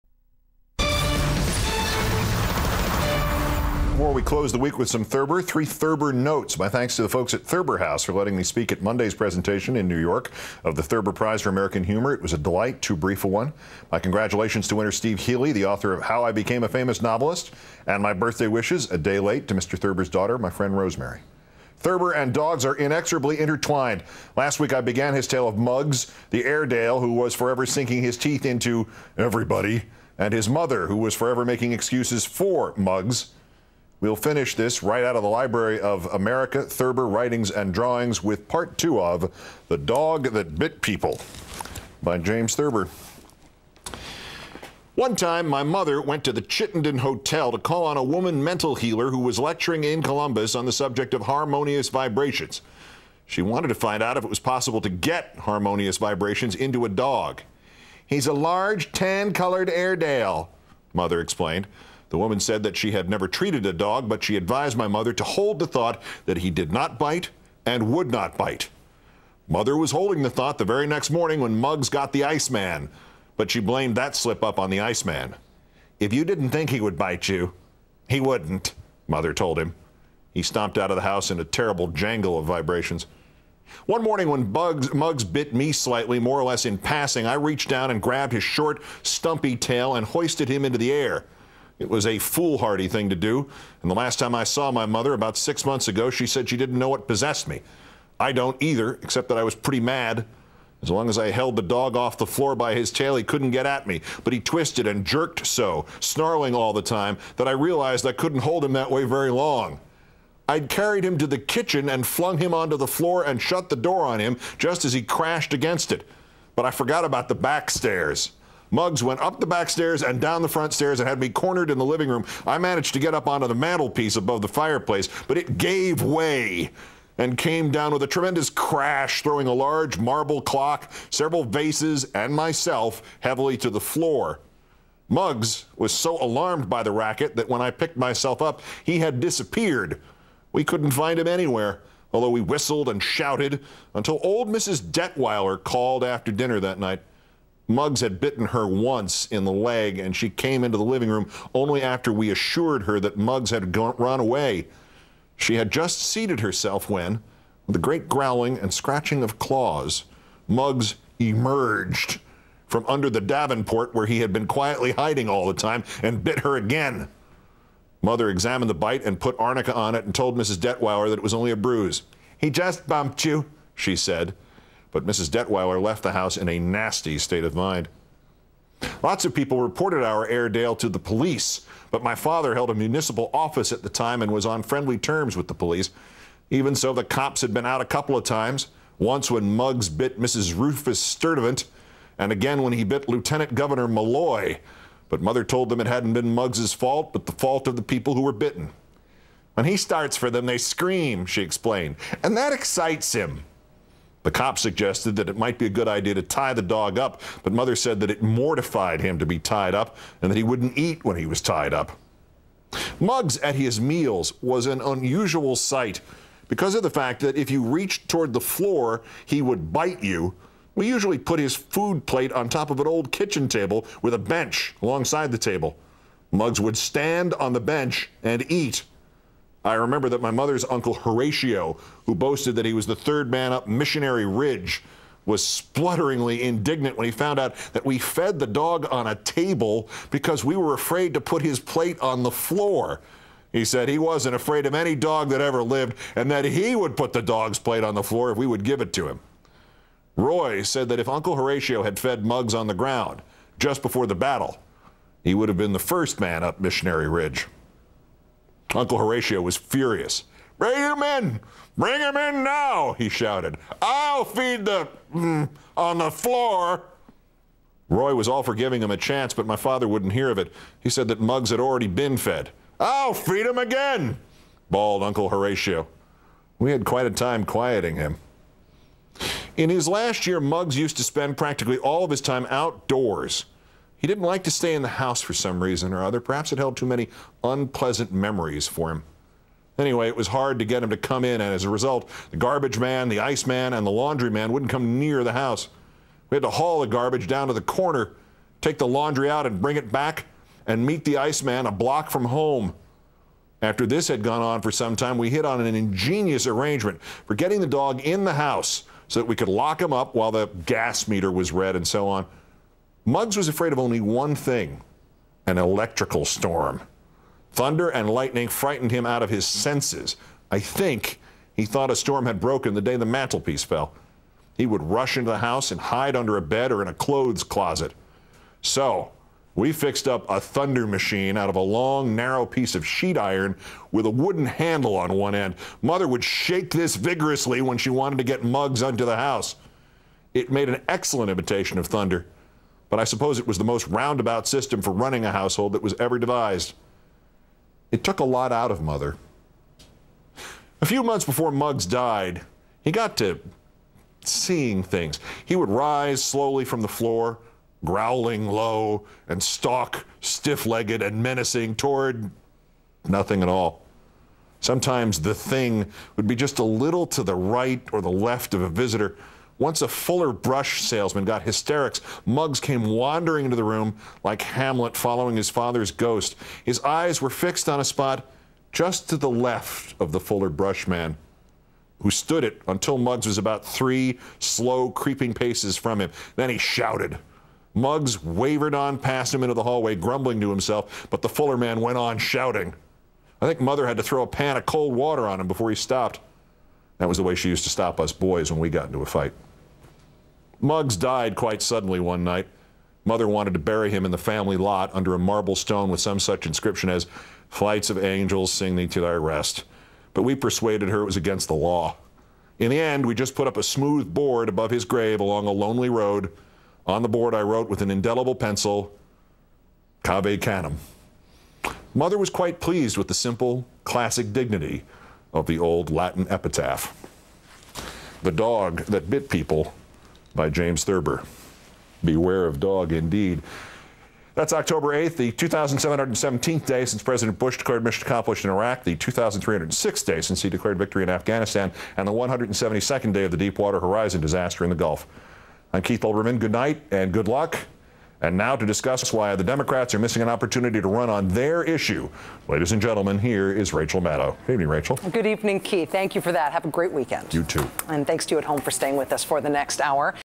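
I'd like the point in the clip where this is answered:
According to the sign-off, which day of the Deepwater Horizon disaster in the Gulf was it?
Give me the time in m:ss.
7:22.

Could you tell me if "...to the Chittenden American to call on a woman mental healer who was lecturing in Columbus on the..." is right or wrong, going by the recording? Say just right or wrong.
wrong.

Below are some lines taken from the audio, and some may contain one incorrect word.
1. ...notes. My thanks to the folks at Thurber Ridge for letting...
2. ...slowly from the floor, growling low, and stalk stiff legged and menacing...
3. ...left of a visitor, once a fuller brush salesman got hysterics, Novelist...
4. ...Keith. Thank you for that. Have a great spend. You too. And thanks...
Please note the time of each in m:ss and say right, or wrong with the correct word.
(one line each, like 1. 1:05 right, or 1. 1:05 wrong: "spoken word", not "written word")
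1. 0:06 wrong: "House", not "Ridge"
2. 5:56 right
3. 6:08 wrong: "Muggs", not "Novelist"
4. 7:35 wrong: "weekend", not "spend".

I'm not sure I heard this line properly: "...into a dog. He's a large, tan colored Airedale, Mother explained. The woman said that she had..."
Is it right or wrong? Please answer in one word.
right.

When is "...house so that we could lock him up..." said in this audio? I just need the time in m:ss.
5:08.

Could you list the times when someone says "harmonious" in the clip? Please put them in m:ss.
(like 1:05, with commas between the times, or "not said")
0:51, 0:55.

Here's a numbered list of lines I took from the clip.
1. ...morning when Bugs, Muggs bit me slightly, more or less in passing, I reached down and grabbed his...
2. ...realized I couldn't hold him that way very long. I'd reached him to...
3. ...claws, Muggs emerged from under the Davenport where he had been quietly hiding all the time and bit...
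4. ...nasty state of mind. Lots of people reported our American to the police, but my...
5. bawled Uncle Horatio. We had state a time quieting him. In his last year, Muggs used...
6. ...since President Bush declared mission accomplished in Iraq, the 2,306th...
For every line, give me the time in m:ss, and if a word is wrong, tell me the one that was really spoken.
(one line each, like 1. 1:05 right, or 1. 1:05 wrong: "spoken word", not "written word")
1. 1:24 right
2. 1:47 wrong: "carried", not "reached"
3. 2:39 right
4. 2:56 wrong: "Airedale", not "American"
5. 4:34 wrong: "quite", not "state"
6. 7:16 right.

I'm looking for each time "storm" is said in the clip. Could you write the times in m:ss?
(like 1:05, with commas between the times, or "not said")
5:16, 5:21.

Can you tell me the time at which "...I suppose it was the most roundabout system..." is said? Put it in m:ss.
5:42.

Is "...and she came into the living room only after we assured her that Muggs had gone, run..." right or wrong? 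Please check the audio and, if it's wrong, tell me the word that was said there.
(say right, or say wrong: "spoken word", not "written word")
right.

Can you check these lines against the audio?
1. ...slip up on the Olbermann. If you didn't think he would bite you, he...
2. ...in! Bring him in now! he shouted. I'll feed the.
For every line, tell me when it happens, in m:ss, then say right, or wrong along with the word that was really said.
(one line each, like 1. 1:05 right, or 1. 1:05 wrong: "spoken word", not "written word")
1. 1:14 wrong: "Iceman", not "Olbermann"
2. 4:21 right.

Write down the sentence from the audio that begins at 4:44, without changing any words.
He didn't like to stay in the house for some reason or other.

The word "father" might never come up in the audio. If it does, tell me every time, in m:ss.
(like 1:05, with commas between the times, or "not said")
3:02, 4:29, 6:15.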